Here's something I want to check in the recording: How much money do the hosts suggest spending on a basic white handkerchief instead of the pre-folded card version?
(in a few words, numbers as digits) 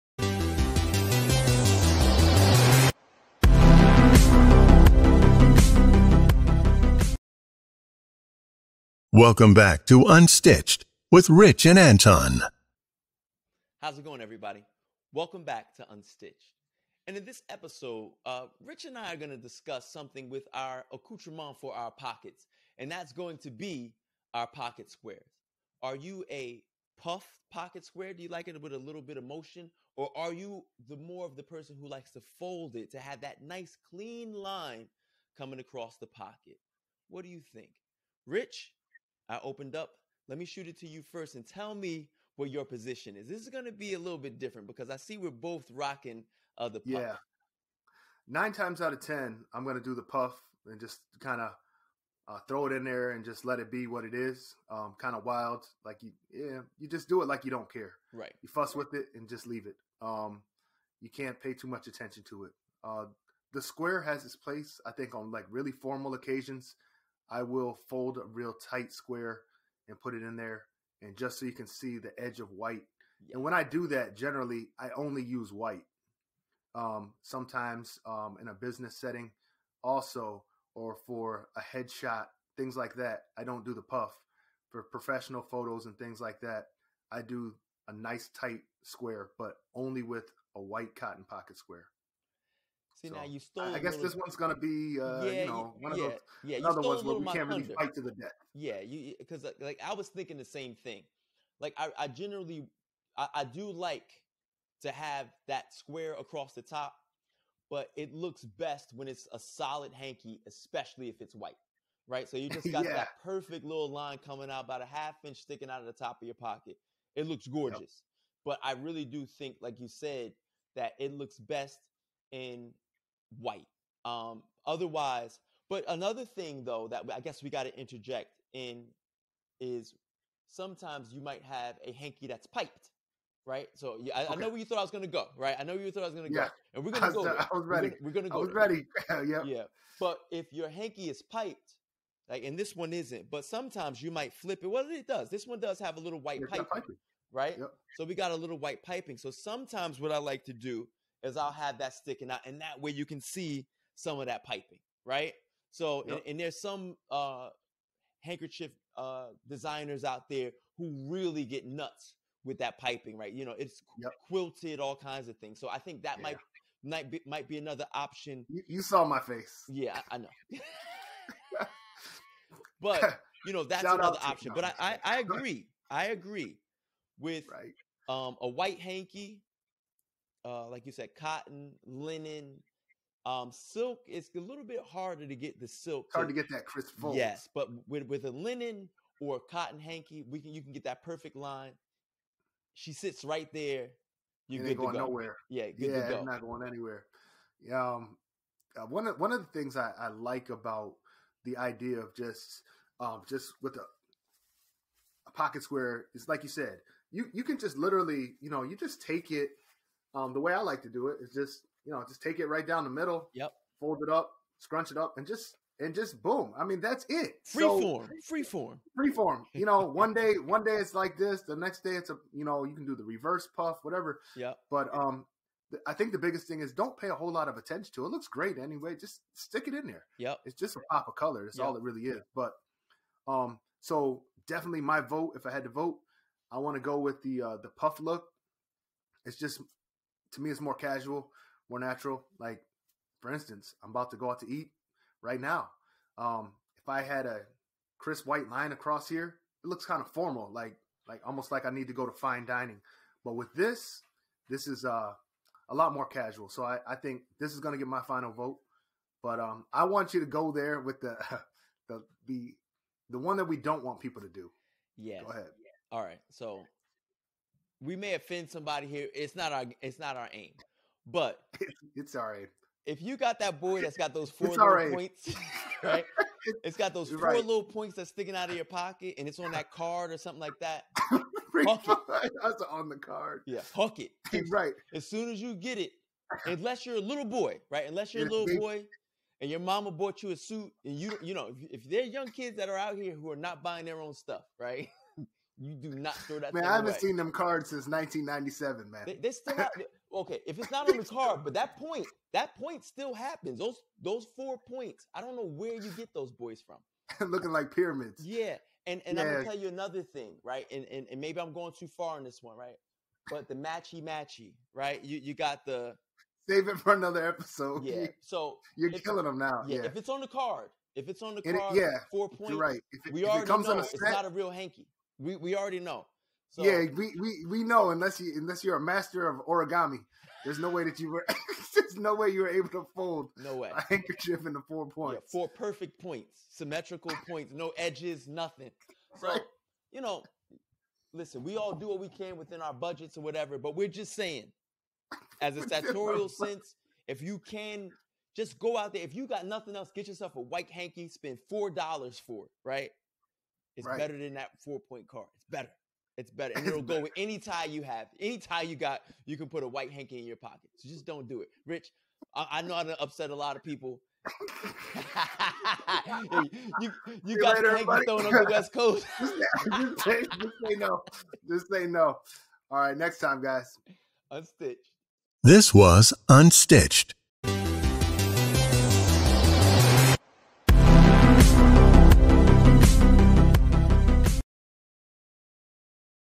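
$4.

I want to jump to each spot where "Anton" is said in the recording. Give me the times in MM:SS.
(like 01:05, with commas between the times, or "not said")
00:11.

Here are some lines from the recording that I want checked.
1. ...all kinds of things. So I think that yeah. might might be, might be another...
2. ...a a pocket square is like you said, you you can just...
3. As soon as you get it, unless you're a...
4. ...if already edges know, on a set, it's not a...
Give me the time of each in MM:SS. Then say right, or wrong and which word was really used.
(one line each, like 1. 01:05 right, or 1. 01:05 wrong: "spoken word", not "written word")
1. 02:44 right
2. 03:23 right
3. 04:44 right
4. 05:23 wrong: "comes", not "edges".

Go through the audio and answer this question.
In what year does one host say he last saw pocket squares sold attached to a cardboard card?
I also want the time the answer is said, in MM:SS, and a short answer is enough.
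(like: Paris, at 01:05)
1997, at 04:57.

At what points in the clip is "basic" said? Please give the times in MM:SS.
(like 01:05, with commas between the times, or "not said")
not said.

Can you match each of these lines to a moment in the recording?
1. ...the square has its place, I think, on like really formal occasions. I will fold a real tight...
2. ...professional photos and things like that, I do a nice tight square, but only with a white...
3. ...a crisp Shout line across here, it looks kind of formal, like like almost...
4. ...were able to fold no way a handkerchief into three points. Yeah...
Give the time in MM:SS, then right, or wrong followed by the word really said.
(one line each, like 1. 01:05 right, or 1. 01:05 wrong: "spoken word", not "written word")
1. 01:03 right
2. 01:24 right
3. 04:07 wrong: "White", not "Shout"
4. 05:32 wrong: "four", not "three".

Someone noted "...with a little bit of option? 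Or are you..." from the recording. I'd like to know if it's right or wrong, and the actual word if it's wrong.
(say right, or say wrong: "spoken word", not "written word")
wrong: "motion", not "option".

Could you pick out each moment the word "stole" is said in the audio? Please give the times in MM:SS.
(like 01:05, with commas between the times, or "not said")
01:33.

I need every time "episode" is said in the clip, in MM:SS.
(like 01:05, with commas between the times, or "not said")
00:17, 05:17.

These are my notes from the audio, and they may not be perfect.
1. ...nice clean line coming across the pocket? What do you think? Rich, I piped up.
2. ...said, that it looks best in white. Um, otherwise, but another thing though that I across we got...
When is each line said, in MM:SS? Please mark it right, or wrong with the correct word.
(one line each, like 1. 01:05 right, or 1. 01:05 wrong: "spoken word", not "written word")
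1. 00:33 wrong: "opened", not "piped"
2. 01:59 wrong: "guess", not "across".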